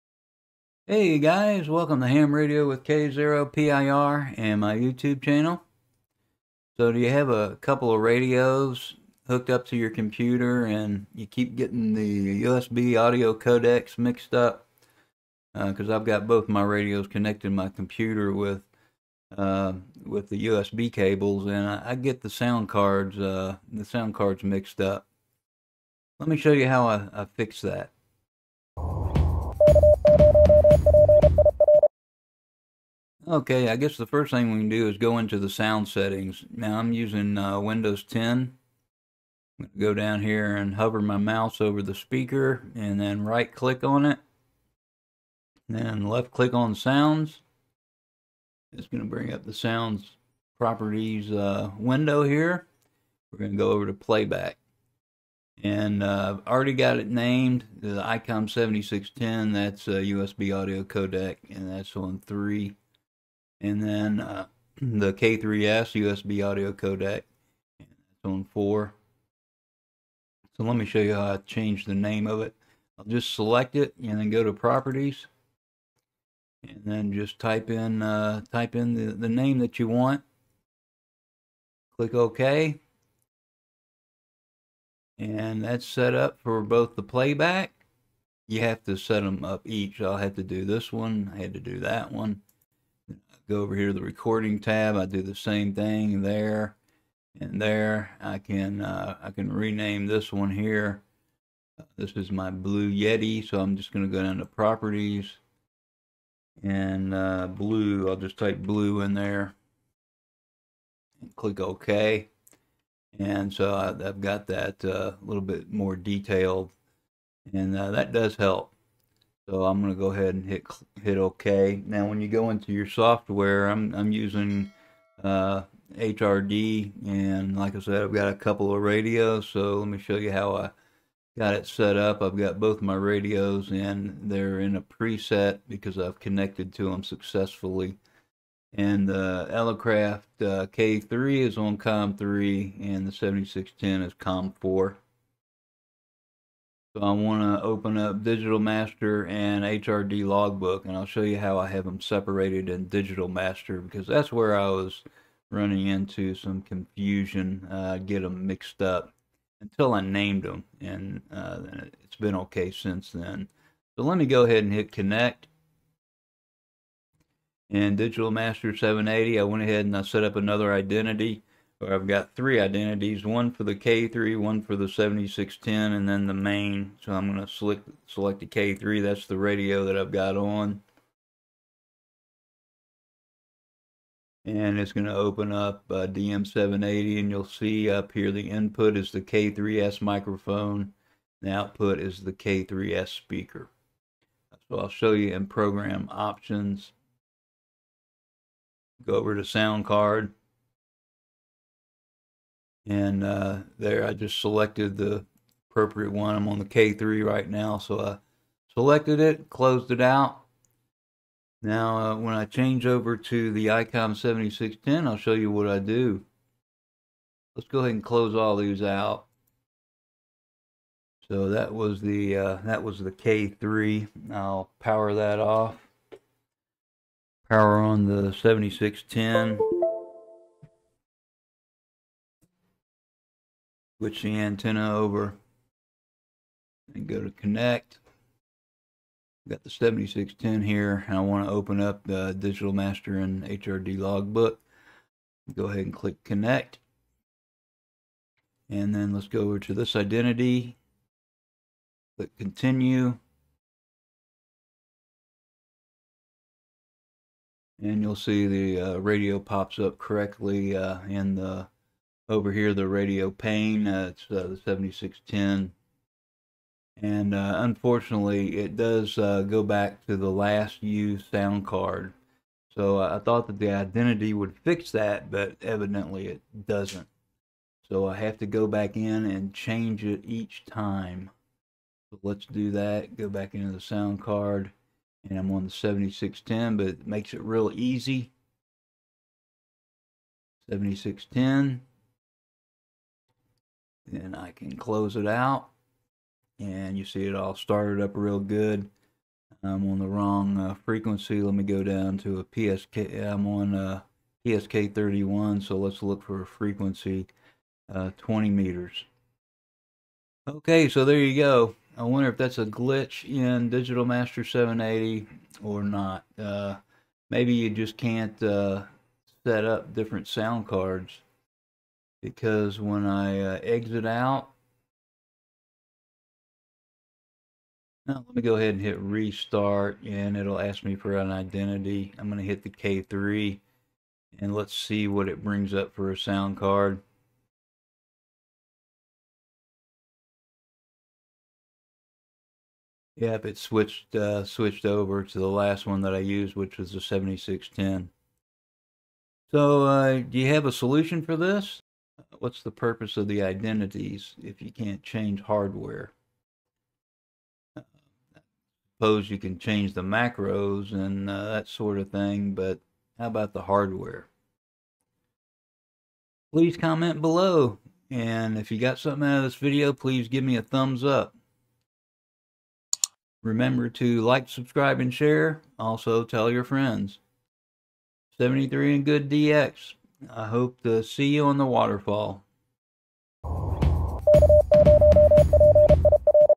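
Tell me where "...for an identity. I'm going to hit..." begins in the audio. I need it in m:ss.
5:30.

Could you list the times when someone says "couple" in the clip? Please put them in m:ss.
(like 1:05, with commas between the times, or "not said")
0:07, 2:08.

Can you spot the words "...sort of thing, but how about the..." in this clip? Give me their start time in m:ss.
6:01.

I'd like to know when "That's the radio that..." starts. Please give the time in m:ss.
2:59.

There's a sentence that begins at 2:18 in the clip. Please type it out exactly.
And the uh, Elecraft uh, K3 is on COM3 and the 7610 is COM4.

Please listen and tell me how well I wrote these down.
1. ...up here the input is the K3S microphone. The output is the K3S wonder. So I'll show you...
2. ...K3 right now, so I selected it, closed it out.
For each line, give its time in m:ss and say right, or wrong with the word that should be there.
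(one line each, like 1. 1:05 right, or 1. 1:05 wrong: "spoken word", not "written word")
1. 3:07 wrong: "speaker", not "wonder"
2. 3:26 right.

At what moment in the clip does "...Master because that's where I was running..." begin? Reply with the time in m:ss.
2:33.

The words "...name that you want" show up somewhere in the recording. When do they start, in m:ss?
1:19.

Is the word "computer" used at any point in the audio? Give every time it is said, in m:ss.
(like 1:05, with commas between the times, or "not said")
0:09, 0:17.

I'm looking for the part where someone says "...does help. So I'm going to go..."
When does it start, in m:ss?
1:58.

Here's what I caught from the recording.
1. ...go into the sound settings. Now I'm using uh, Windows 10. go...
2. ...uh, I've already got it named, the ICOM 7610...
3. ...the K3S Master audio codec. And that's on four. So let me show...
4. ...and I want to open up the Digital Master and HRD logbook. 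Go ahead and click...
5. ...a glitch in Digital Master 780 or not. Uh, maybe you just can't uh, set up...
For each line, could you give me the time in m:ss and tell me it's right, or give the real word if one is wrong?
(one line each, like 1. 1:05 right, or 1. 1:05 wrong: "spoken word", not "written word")
1. 0:34 right
2. 0:56 right
3. 1:04 wrong: "USB", not "Master"
4. 4:01 right
5. 5:12 right.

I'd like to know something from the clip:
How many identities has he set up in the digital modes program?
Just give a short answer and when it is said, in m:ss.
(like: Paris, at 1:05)
3, at 2:52.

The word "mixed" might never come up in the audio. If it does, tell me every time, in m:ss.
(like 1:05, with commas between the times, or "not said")
0:13, 0:24, 2:38.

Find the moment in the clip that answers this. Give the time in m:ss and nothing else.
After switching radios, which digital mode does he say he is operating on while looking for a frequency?
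5:04.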